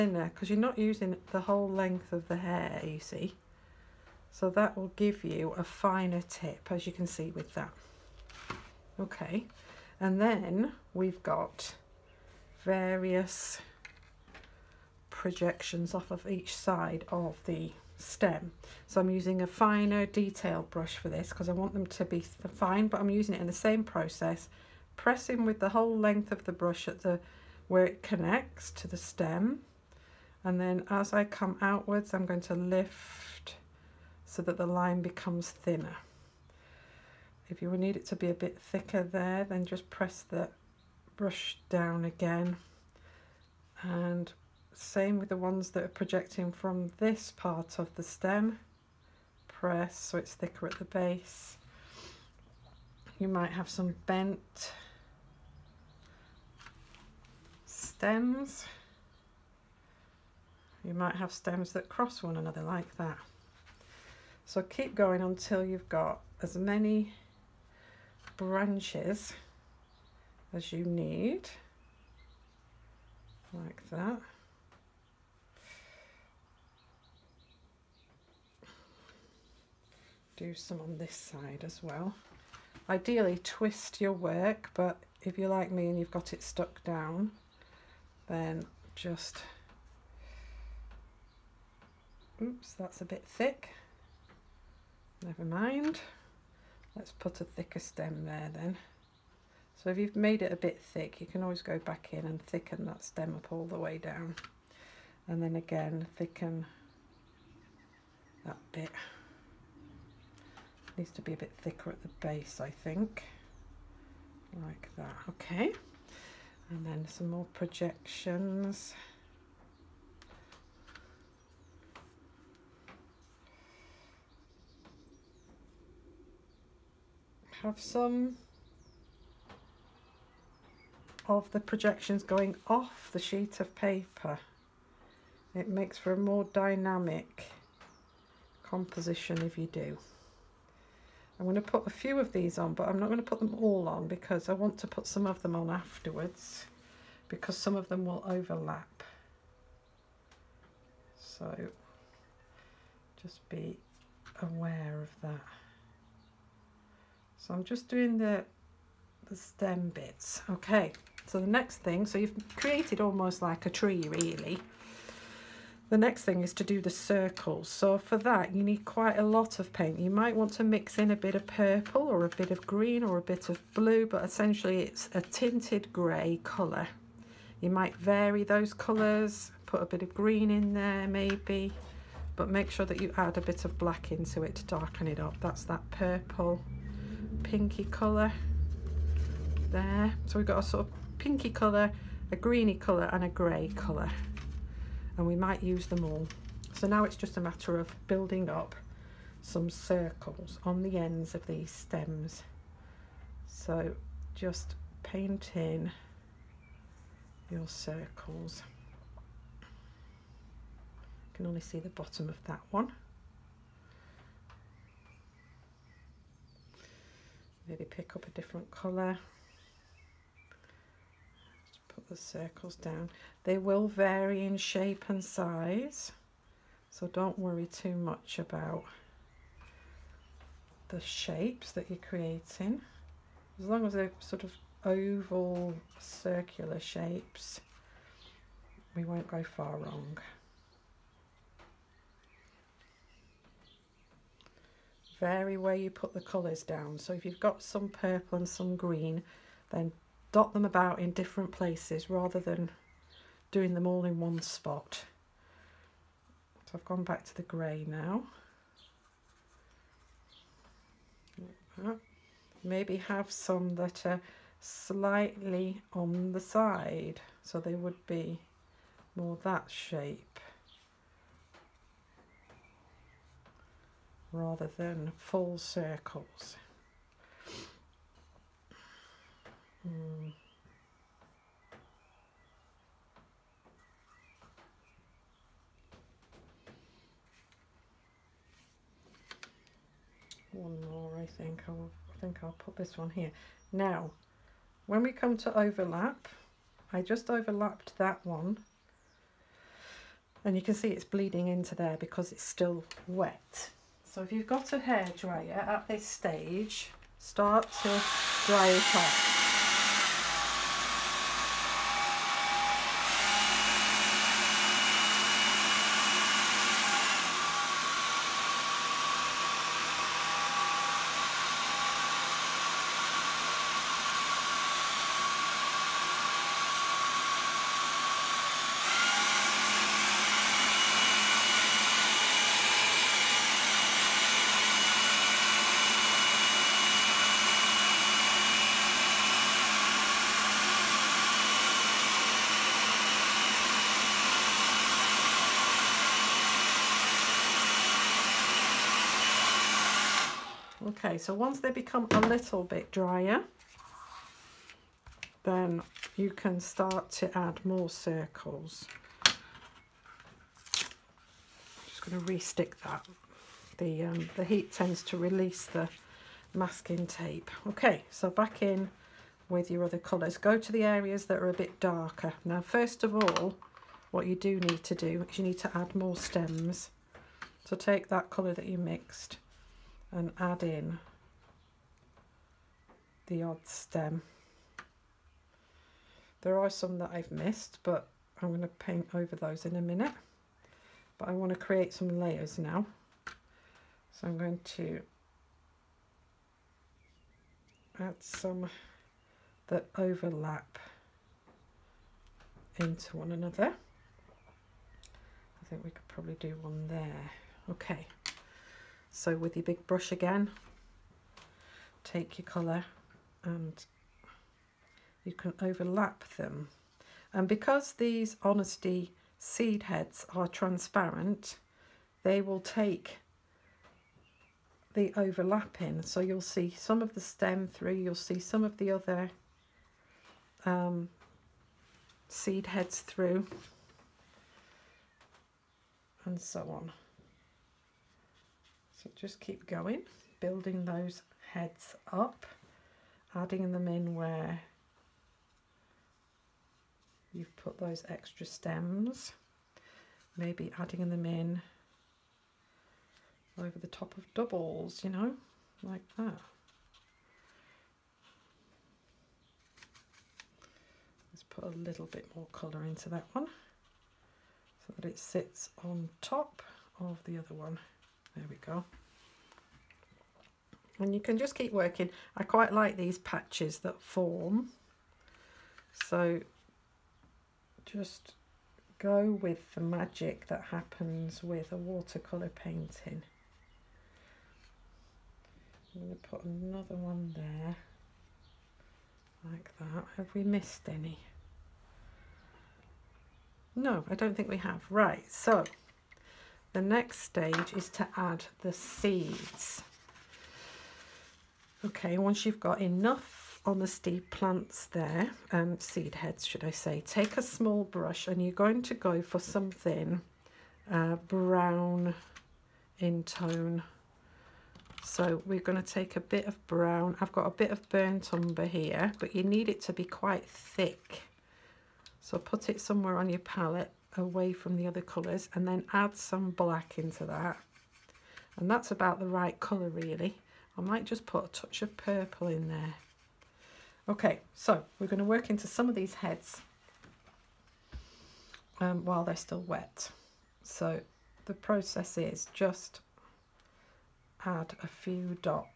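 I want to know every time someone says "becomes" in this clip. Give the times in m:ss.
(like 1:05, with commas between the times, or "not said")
0:35, 5:51.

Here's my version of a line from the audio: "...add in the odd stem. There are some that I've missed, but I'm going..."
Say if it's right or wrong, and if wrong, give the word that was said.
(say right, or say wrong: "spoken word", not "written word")
right.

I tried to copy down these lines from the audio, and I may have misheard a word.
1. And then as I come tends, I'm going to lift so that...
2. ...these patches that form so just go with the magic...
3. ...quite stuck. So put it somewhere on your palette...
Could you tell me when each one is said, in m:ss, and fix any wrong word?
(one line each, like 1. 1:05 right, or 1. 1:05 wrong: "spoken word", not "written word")
1. 0:30 wrong: "outwards", not "tends"
2. 7:52 right
3. 8:40 wrong: "thick", not "stuck".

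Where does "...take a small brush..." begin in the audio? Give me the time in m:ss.
8:27.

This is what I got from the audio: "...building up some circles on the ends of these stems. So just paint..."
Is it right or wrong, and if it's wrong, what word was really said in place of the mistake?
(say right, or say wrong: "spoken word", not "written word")
right.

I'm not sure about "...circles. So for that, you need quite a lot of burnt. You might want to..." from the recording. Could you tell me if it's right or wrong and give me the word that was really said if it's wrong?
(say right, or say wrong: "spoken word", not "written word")
wrong: "paint", not "burnt".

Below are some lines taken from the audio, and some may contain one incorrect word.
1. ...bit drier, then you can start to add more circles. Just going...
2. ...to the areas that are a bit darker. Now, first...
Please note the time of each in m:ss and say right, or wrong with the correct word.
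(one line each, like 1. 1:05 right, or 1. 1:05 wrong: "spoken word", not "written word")
1. 5:52 right
2. 6:10 right.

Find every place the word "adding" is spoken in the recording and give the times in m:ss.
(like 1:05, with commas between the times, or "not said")
7:23, 7:30.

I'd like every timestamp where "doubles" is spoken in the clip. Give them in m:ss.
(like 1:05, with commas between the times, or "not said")
7:34.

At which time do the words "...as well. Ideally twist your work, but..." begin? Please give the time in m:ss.
1:21.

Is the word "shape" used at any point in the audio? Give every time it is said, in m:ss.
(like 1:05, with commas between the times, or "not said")
3:44, 3:51, 3:56, 4:29.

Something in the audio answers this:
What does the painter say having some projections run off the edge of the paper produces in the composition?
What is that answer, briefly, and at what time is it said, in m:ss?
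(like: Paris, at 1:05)
more dynamic composition, at 2:16.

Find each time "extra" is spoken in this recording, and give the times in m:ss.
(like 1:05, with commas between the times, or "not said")
7:28.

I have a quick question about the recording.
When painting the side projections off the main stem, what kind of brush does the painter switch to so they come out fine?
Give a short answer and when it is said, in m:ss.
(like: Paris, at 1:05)
finer detail brush, at 0:19.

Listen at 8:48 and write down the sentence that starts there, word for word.
And that's about the right colour really.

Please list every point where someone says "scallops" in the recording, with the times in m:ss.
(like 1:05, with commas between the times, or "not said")
not said.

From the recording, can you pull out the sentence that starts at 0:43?
And same with the ones that are projecting from this part of the stem.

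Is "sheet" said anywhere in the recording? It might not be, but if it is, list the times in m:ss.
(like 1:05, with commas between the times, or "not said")
2:13.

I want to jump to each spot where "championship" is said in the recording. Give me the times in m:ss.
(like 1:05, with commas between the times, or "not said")
not said.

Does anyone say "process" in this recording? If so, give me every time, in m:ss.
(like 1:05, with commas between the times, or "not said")
0:23, 9:01.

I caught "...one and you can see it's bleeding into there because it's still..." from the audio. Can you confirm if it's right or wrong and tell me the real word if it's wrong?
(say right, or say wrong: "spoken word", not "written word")
right.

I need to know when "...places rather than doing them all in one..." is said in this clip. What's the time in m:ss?
4:11.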